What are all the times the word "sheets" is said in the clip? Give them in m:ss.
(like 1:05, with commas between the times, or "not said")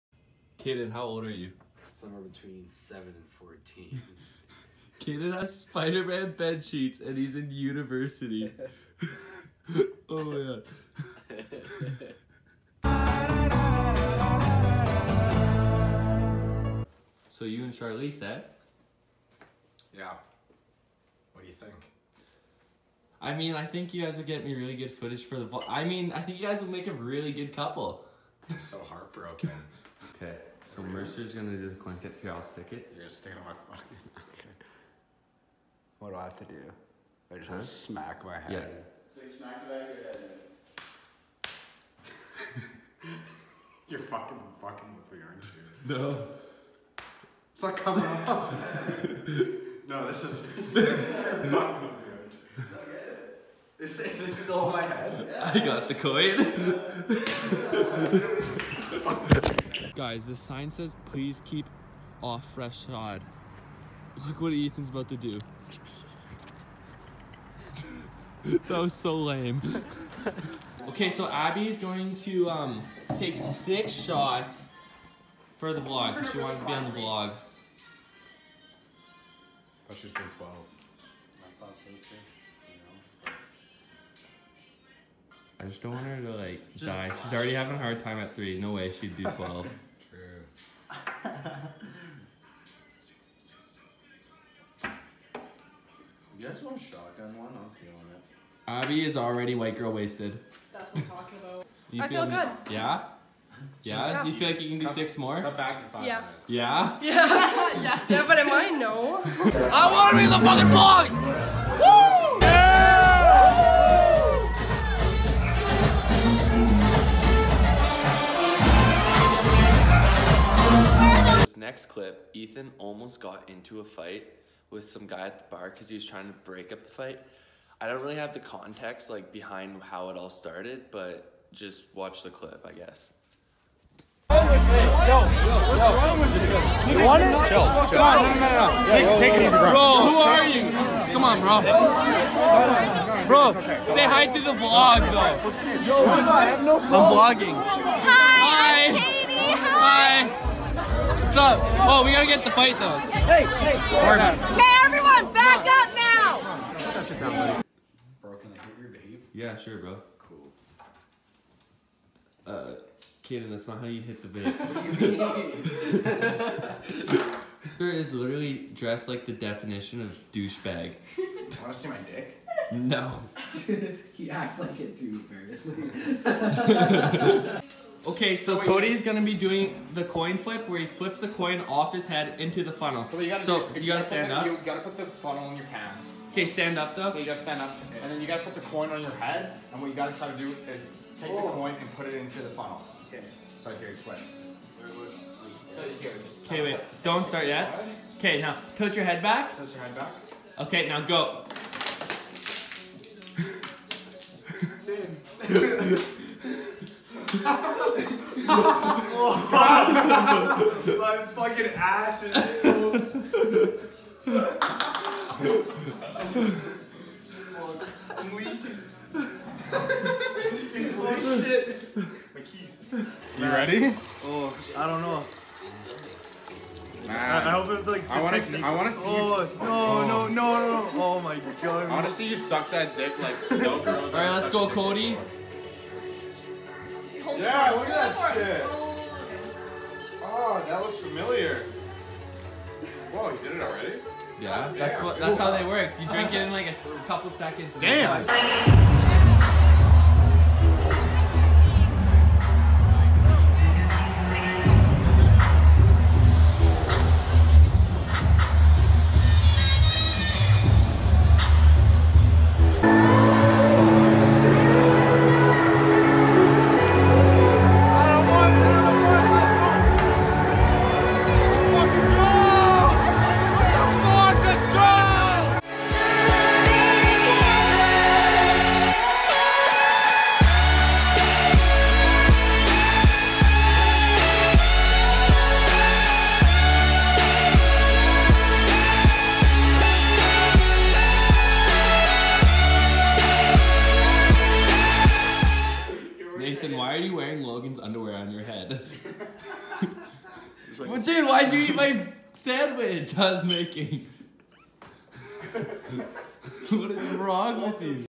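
0:06.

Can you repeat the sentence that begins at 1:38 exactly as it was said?
Abby is already white girl wasted.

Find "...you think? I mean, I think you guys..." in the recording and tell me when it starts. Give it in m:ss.
0:21.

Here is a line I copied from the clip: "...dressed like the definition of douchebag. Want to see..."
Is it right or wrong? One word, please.
right.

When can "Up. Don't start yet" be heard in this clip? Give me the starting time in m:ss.
3:16.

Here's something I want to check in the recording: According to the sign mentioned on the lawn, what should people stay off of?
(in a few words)
fresh sod.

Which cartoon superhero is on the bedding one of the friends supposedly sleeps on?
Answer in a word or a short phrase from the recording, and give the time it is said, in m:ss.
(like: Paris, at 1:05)
Spider Man, at 0:05.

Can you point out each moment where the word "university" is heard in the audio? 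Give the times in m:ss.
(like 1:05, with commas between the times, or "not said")
0:07.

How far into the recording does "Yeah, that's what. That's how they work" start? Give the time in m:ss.
4:04.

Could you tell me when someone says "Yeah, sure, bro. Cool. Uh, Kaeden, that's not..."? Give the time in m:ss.
2:39.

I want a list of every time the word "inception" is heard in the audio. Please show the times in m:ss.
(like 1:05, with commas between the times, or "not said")
not said.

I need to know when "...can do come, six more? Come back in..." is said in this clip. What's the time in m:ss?
1:44.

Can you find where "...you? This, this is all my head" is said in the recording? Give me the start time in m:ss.
0:51.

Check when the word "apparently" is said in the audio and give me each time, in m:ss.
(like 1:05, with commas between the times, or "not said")
2:56.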